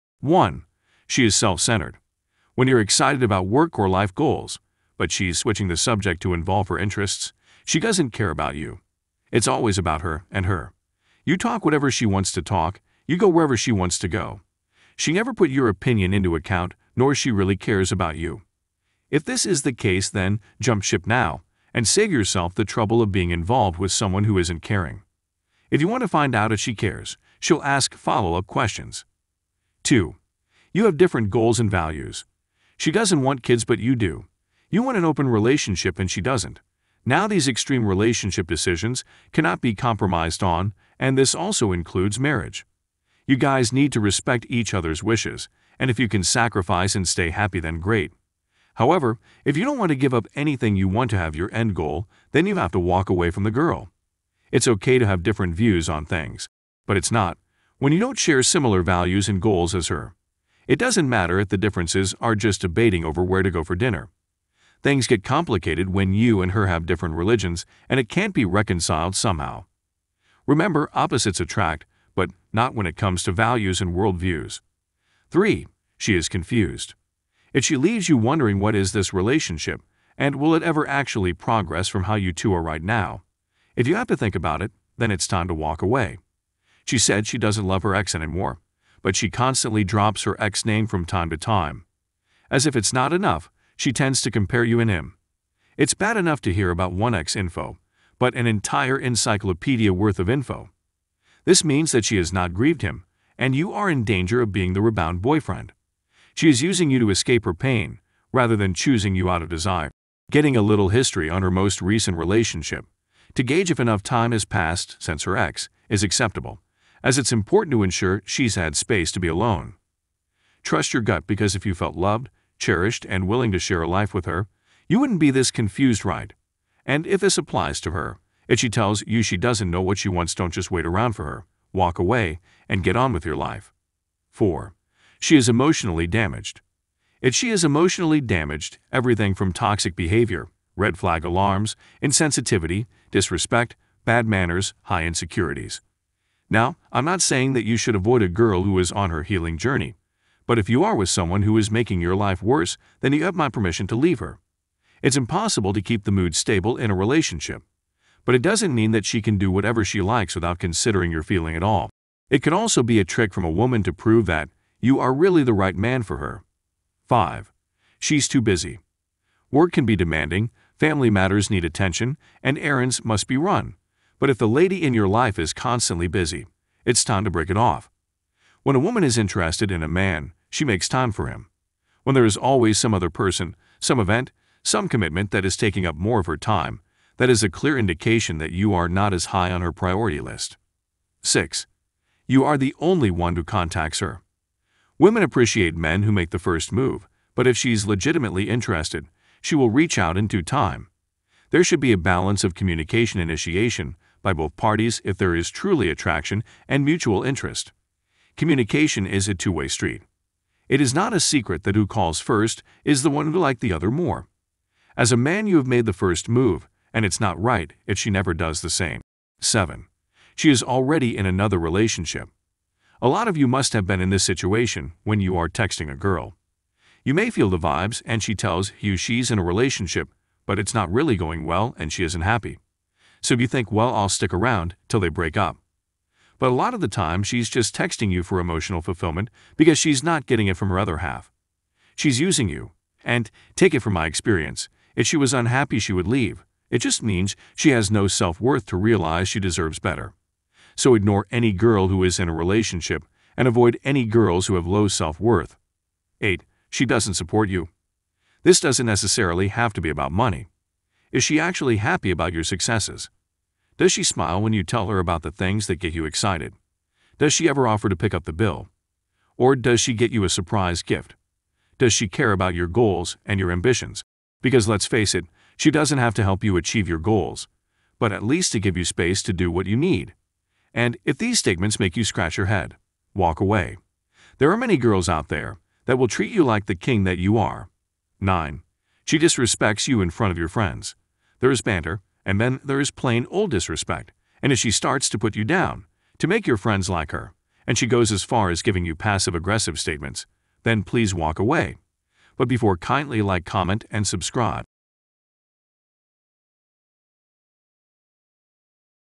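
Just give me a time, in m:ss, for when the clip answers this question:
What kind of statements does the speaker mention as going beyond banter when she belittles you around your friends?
4:58.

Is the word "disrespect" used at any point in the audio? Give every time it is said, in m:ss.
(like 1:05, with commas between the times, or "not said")
2:23, 4:49, 4:53.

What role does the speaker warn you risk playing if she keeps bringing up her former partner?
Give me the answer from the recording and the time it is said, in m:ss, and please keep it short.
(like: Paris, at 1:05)
Rebound boyfriend, at 1:44.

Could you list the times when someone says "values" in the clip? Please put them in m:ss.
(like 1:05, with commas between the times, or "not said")
0:31, 0:58, 1:13.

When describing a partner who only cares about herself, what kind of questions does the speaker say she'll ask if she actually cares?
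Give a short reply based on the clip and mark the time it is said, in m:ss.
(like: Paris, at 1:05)
Follow-up questions, at 0:27.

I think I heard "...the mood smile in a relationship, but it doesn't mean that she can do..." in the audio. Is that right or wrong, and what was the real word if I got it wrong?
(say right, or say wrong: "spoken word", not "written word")
wrong: "stable", not "smile".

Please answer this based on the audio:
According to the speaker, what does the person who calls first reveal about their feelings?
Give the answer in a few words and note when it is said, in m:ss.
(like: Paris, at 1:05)
Liked the other more, at 3:33.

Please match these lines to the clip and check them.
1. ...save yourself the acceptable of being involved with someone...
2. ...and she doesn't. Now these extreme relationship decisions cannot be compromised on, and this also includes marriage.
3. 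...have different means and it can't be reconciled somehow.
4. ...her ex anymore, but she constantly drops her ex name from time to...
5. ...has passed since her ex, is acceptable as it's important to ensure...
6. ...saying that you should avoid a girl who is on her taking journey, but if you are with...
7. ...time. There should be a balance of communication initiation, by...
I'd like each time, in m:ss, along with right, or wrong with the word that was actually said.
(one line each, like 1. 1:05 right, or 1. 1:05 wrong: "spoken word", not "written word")
1. 0:21 wrong: "trouble", not "acceptable"
2. 0:35 right
3. 1:06 wrong: "religions", not "means"
4. 1:27 right
5. 1:54 right
6. 2:27 wrong: "healing", not "taking"
7. 3:20 right.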